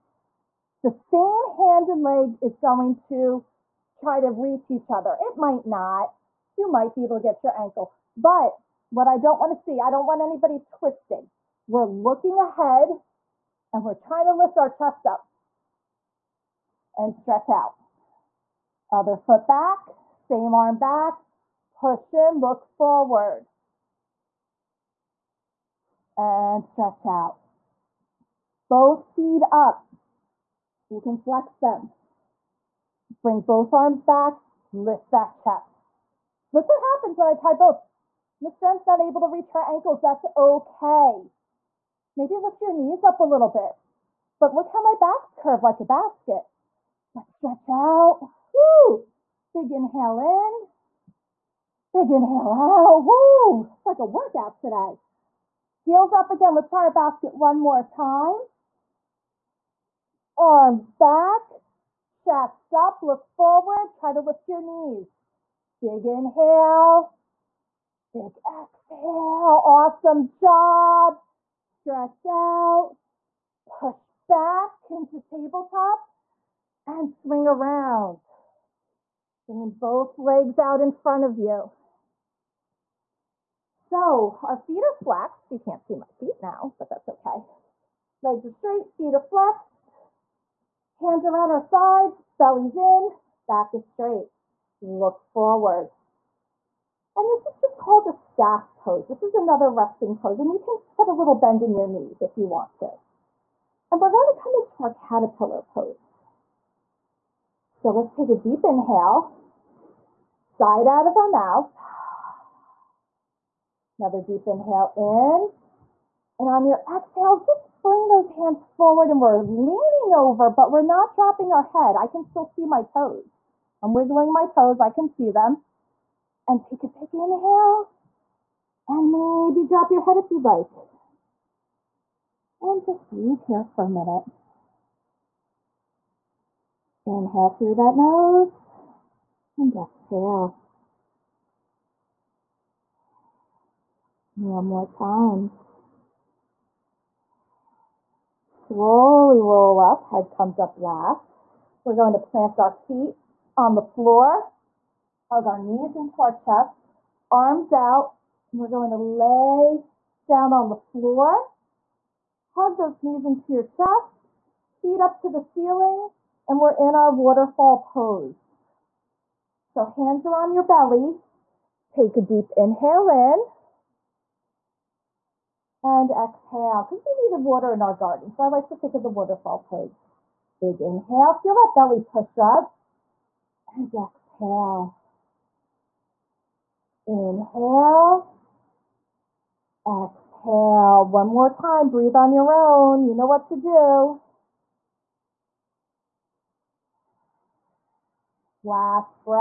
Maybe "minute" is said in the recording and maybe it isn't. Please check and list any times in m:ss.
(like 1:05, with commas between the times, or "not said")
2:13.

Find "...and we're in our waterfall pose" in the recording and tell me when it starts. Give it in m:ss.
2:46.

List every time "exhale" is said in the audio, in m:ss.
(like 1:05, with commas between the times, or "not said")
1:08, 1:56, 2:19, 2:56, 3:03, 3:09.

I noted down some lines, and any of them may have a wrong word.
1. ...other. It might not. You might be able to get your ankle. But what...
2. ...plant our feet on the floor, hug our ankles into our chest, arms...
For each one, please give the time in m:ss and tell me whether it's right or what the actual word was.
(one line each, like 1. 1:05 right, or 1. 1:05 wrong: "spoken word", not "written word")
1. 0:04 right
2. 2:32 wrong: "knees", not "ankles".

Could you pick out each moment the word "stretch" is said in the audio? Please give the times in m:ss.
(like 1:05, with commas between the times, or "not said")
0:17, 0:26, 0:47, 1:11.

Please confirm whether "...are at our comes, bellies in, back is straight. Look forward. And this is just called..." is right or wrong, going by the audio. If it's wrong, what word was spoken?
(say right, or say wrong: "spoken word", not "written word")
wrong: "sides", not "comes".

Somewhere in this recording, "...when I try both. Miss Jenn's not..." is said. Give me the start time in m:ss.
0:37.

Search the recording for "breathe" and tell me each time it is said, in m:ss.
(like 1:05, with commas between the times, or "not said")
2:13, 3:11.